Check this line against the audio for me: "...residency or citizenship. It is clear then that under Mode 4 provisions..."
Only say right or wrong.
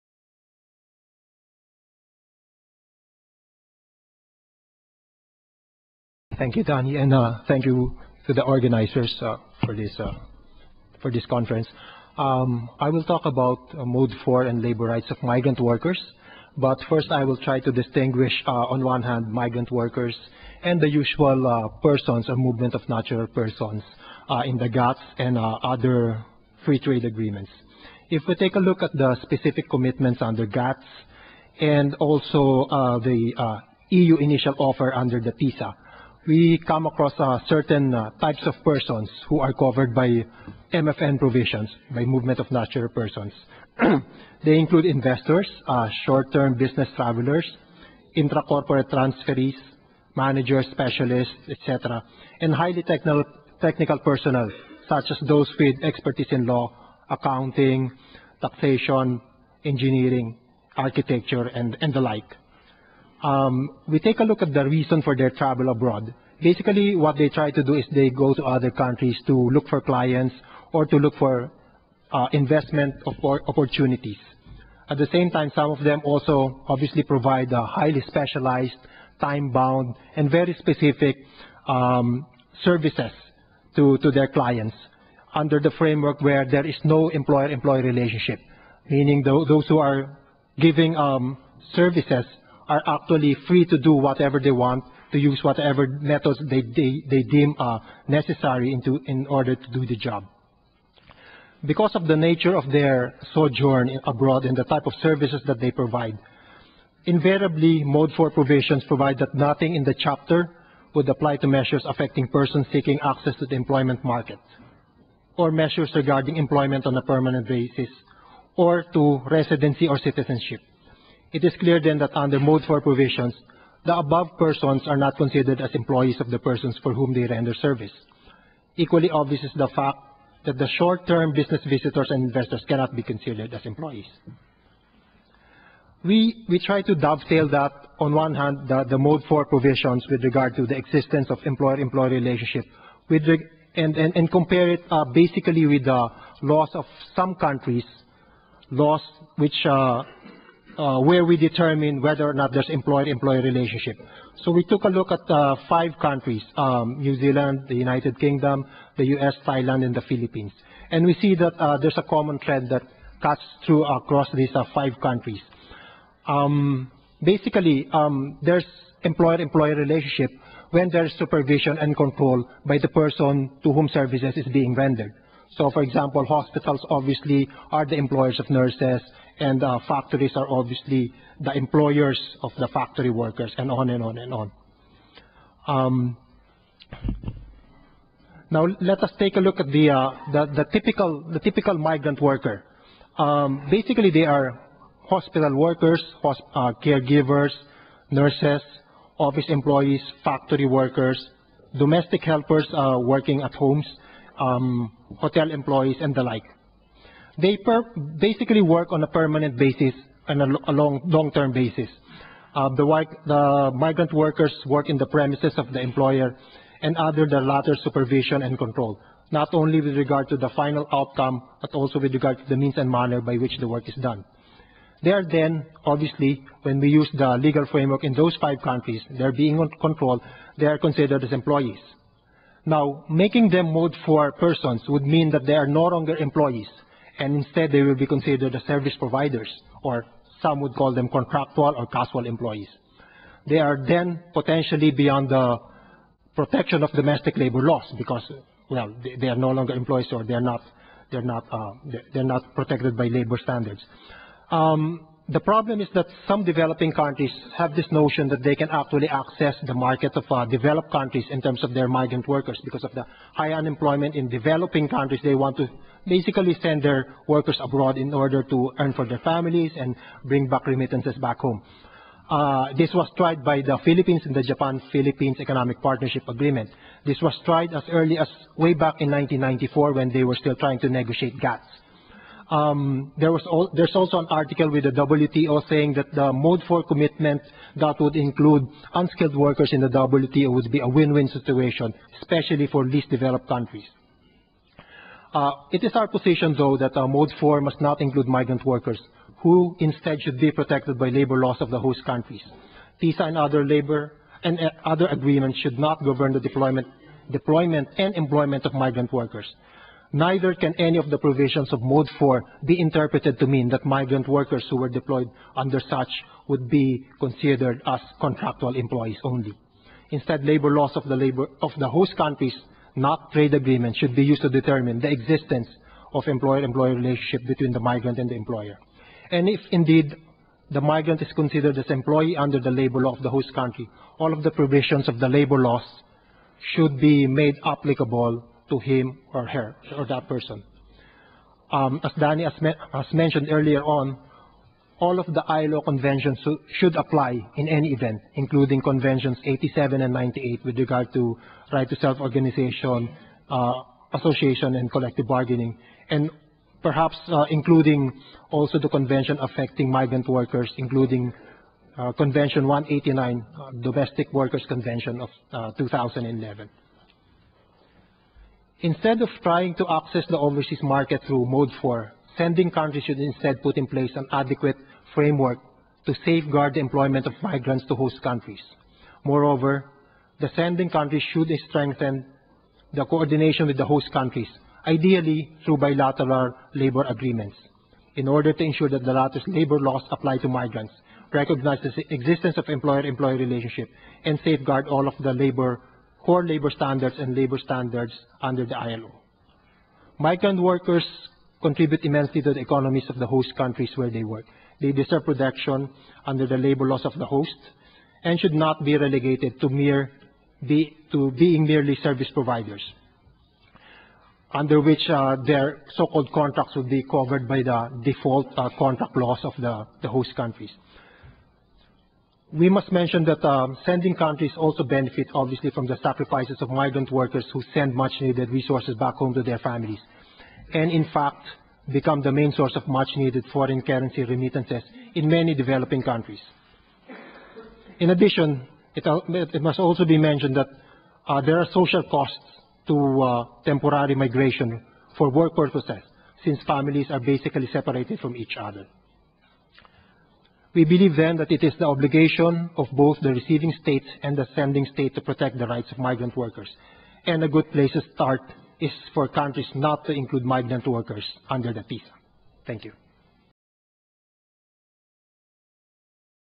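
right.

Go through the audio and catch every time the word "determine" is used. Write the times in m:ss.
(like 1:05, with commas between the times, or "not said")
2:31, 5:24.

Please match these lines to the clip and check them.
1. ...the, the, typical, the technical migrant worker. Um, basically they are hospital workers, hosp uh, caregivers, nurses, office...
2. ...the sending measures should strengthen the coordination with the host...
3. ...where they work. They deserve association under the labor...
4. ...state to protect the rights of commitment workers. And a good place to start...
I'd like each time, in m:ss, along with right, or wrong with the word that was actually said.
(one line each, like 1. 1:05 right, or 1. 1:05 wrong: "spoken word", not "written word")
1. 3:10 wrong: "typical", not "technical"
2. 6:20 wrong: "countries", not "measures"
3. 6:43 wrong: "protection", not "association"
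4. 7:34 wrong: "migrant", not "commitment".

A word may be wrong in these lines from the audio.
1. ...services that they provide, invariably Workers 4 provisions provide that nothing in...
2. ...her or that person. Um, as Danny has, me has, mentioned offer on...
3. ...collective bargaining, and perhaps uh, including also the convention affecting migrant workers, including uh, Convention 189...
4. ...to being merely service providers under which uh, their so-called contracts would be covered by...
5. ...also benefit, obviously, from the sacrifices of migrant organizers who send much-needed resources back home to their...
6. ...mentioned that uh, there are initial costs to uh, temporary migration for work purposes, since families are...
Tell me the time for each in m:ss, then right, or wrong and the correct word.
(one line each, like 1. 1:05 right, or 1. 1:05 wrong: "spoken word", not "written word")
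1. 1:45 wrong: "Mode", not "Workers"
2. 5:39 wrong: "earlier", not "offer"
3. 5:54 right
4. 6:51 right
5. 7:04 wrong: "workers", not "organizers"
6. 7:20 wrong: "social", not "initial".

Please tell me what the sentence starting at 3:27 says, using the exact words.
They basically work on a permanent basis and a, a long, long-term basis.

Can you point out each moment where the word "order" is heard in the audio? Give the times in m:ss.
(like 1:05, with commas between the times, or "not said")
1:39, 4:28, 6:28.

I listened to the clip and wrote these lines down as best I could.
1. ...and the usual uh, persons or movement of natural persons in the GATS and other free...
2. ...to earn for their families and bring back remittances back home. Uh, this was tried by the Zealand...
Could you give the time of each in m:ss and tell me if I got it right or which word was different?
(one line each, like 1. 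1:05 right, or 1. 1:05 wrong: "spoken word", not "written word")
1. 0:20 right
2. 4:28 wrong: "Philippines", not "Zealand".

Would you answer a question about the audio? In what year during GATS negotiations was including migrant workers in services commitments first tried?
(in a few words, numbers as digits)
1994.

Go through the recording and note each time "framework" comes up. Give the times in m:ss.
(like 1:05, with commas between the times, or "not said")
1:25, 3:47, 6:15.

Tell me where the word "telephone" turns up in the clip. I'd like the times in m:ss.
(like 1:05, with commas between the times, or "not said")
not said.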